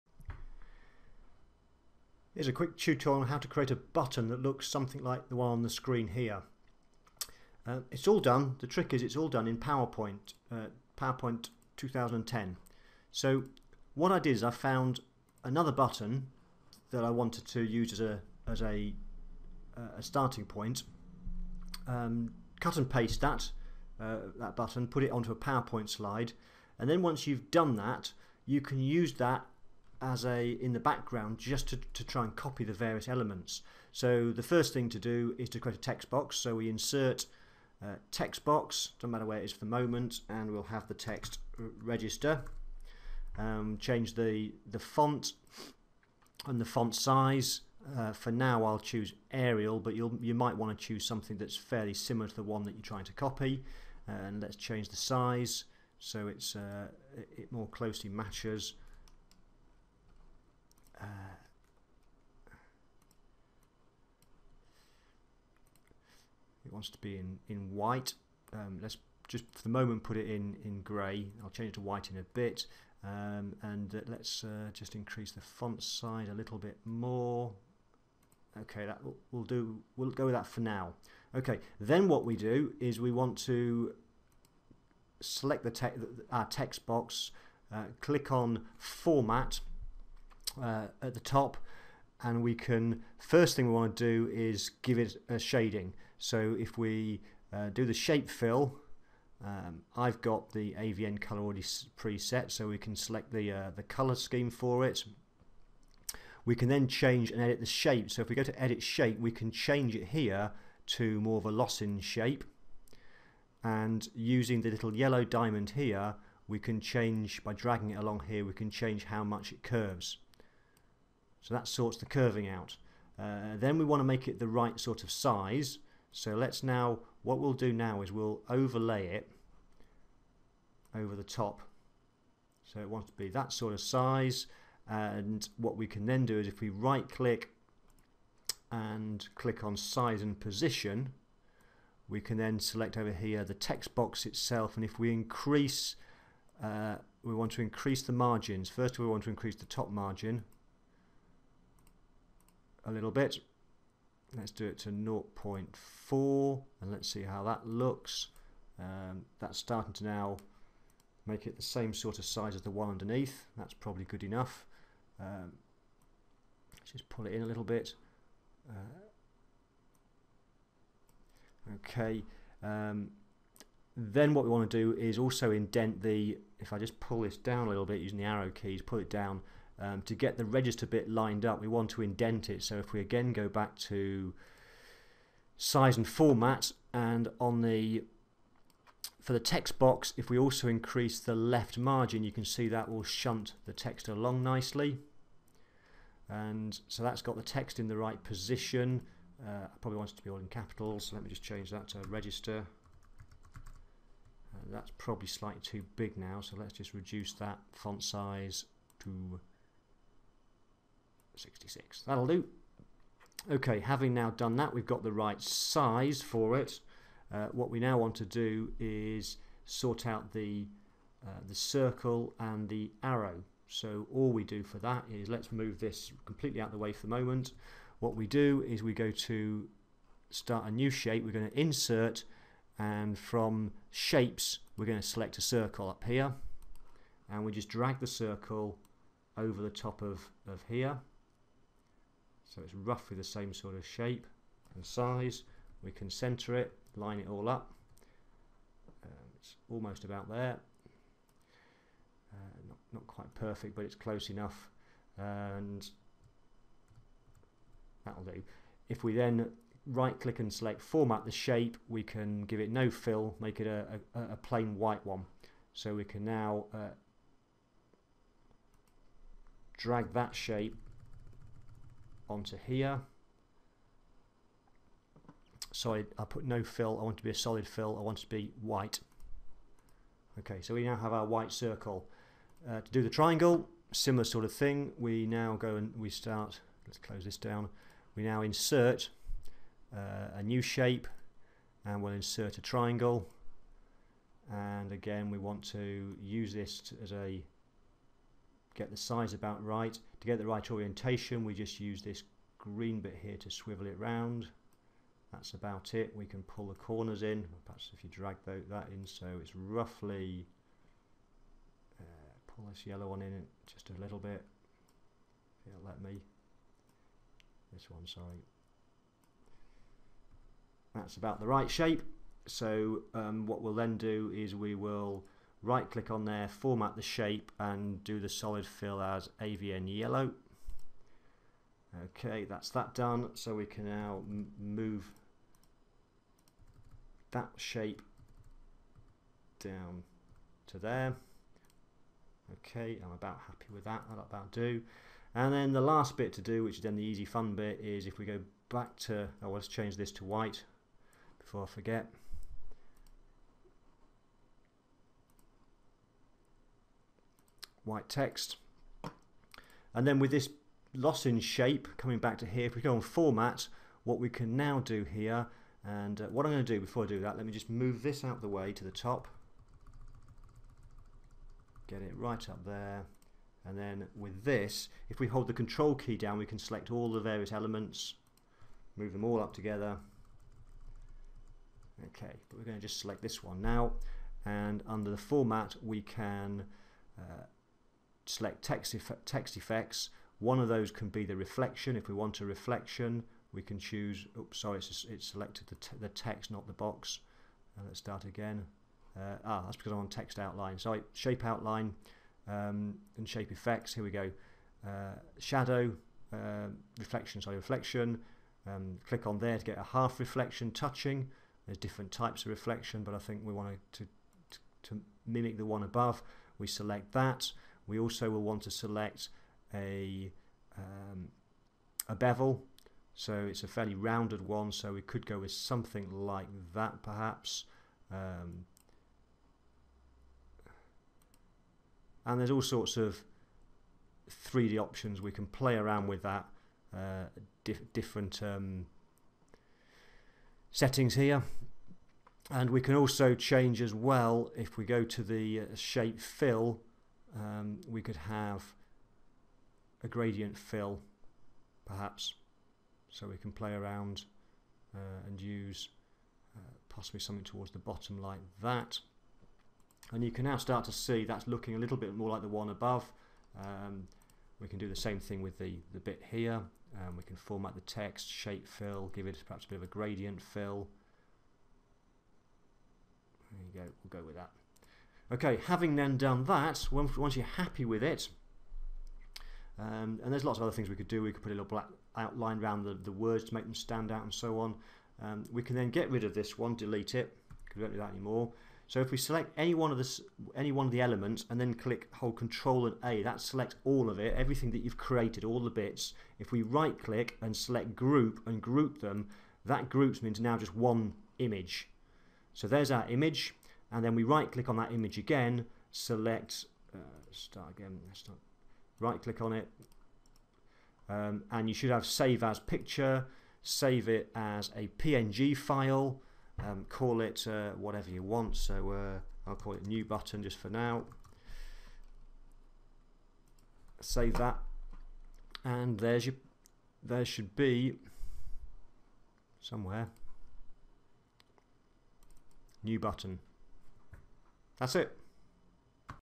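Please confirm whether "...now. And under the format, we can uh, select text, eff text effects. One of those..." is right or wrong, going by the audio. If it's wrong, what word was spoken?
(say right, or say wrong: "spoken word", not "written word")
right.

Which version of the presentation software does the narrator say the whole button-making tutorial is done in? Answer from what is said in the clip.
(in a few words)
PowerPoint 2010.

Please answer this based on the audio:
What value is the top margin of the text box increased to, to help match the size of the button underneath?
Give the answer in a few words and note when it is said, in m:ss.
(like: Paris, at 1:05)
0.4, at 2:34.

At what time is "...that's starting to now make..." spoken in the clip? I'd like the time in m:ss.
2:39.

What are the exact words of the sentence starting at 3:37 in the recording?
Uh, what we now want to do is sort out the, uh, the circle and the arrow.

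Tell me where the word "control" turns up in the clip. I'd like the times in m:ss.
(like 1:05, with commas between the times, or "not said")
6:15, 8:12.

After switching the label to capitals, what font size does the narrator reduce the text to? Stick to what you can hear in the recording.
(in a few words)
66.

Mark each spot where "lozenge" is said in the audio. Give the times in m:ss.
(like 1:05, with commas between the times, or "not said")
1:51, 6:00.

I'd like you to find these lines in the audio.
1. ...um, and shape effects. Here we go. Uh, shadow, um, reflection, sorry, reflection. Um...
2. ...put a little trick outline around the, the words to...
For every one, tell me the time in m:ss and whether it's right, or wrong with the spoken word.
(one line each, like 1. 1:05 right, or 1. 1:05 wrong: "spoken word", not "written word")
1. 6:42 right
2. 8:01 wrong: "black", not "trick".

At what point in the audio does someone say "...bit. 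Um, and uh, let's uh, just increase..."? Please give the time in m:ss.
1:12.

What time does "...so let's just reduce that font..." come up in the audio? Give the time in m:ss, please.
3:26.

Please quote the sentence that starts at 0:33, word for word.
So the first thing to do is to create a text box.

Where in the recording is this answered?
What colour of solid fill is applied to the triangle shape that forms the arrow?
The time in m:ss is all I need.
5:29.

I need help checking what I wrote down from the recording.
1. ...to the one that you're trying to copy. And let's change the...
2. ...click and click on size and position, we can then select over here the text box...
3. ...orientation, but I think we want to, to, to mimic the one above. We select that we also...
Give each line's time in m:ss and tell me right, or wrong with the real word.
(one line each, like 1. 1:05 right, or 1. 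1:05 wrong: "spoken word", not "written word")
1. 0:52 right
2. 2:17 right
3. 6:52 wrong: "reflection", not "orientation".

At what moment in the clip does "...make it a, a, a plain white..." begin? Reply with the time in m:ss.
4:23.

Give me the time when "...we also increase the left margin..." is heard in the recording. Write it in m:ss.
3:10.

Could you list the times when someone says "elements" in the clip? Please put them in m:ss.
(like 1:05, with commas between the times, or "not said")
0:33, 6:17, 8:10.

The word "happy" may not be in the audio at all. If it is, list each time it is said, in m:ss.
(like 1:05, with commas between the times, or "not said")
5:43, 7:57.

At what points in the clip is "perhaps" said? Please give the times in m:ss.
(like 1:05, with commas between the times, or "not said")
5:07, 7:07, 7:31, 7:49.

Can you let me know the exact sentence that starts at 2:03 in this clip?
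Uh, then we want to make it the right sort of size.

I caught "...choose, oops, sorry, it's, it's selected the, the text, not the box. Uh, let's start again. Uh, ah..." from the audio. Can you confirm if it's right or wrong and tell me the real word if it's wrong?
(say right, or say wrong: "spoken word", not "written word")
right.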